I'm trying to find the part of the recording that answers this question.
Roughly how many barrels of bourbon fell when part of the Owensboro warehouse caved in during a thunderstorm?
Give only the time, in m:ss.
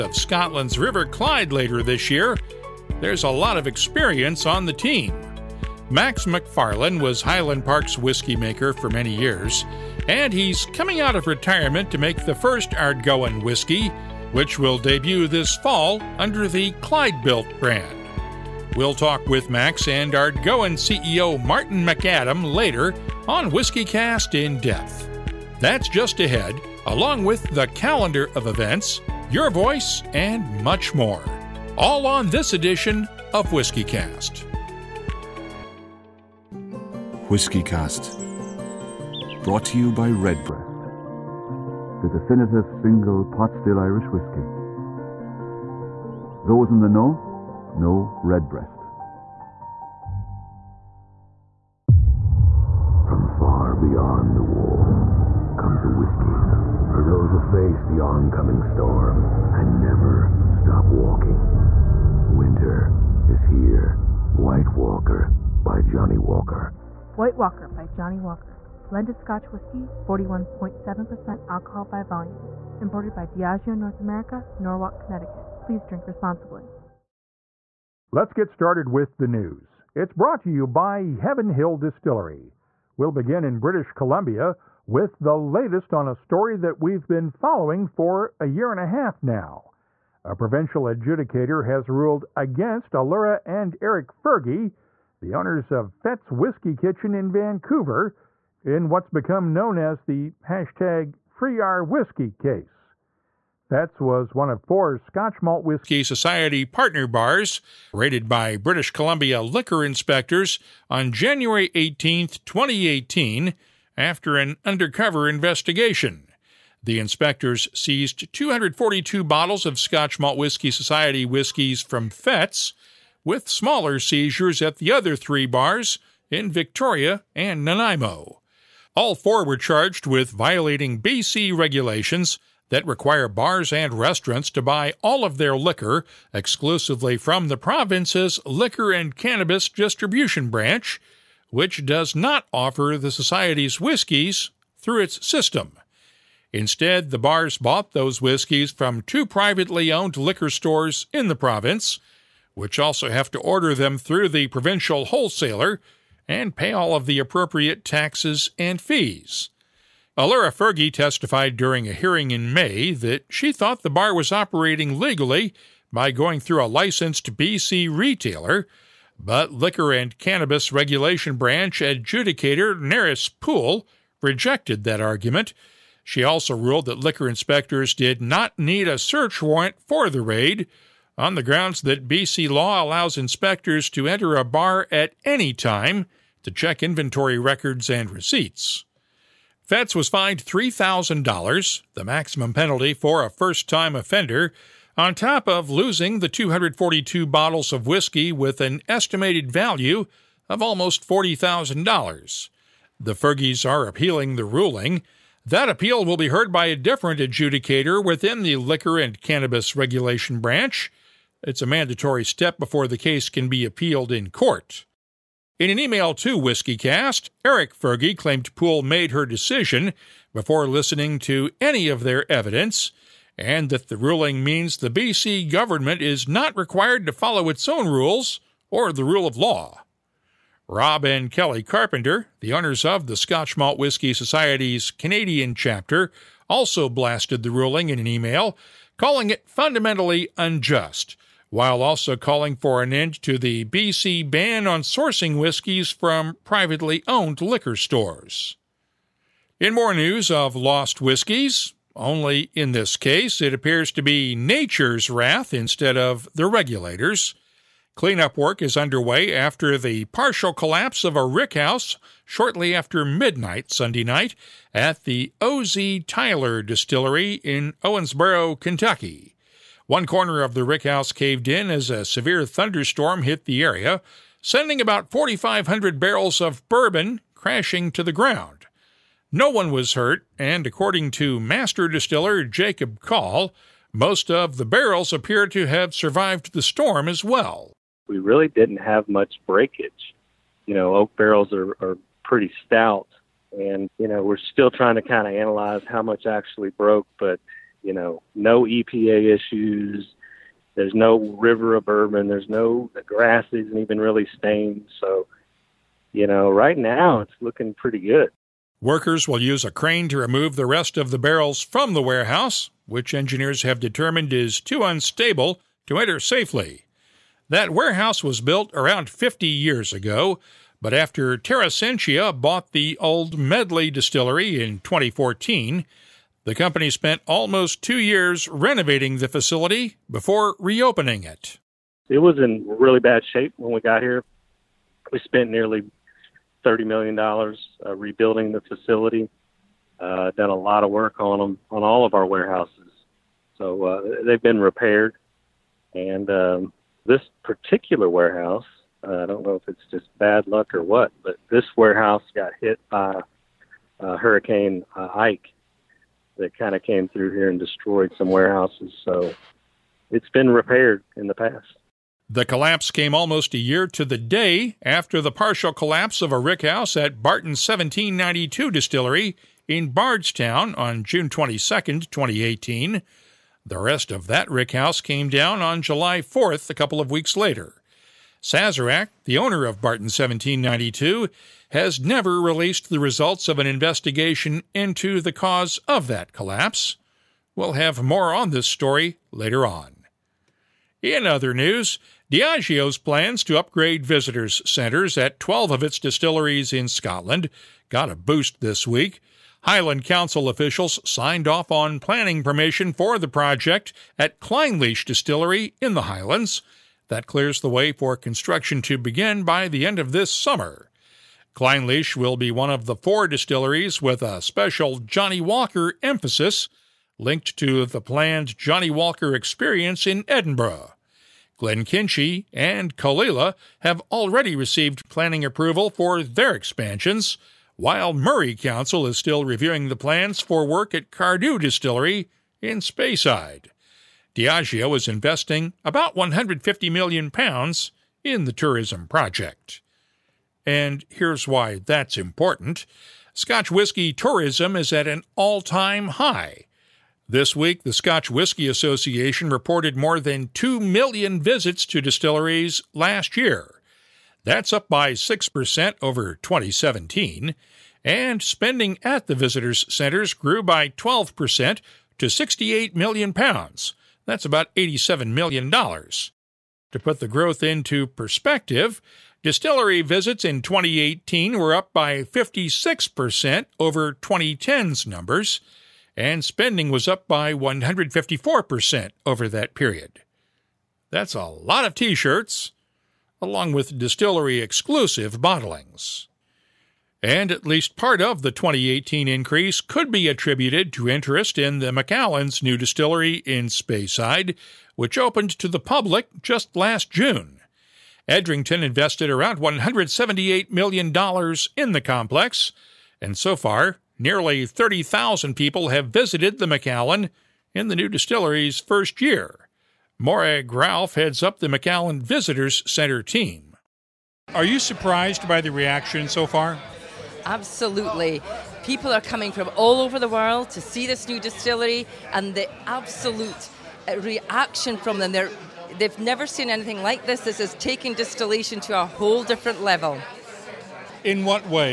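4:35.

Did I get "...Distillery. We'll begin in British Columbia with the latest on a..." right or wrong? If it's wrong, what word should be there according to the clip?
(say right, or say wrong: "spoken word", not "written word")
right.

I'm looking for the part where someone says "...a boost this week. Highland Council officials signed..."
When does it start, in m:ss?
6:38.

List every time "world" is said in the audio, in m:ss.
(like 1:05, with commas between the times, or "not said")
8:40.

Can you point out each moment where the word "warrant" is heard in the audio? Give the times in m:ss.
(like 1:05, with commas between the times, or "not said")
2:59.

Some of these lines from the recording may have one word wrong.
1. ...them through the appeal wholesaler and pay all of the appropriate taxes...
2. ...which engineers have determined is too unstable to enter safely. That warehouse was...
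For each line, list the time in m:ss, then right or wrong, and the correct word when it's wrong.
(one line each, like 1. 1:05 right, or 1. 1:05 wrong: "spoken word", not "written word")
1. 2:33 wrong: "provincial", not "appeal"
2. 5:12 right.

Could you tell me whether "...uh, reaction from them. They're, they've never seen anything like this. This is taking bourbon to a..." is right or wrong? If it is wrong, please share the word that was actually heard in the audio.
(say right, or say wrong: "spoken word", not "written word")
wrong: "distillation", not "bourbon".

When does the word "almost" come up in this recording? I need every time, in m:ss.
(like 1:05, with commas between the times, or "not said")
3:20, 5:27, 6:03.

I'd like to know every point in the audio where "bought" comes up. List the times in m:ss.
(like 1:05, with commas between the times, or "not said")
2:27, 5:22.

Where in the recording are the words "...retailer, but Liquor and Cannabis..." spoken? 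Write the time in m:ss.
2:47.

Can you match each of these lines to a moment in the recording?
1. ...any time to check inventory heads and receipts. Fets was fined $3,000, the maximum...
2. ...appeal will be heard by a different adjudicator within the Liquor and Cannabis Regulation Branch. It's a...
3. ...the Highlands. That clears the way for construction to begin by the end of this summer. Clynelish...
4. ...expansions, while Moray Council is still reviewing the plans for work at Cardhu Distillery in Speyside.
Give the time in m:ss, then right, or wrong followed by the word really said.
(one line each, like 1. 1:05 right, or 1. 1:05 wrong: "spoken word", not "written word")
1. 3:05 wrong: "records", not "heads"
2. 3:25 right
3. 6:45 right
4. 7:06 right.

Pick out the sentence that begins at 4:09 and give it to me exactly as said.
In more news of lost whiskeys, only in this case it appears to be nature's wrath instead of the regulators.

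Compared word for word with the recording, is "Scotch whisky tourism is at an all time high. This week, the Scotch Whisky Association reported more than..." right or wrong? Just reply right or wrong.
right.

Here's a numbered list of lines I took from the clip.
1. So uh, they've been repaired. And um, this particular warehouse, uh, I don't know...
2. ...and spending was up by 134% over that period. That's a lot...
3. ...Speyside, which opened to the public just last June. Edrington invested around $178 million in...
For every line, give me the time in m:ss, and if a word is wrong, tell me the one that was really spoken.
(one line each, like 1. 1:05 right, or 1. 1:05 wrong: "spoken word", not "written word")
1. 5:43 right
2. 7:56 wrong: "154", not "134"
3. 8:13 right.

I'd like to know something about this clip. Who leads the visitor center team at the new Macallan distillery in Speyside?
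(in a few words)
Morag Ralph.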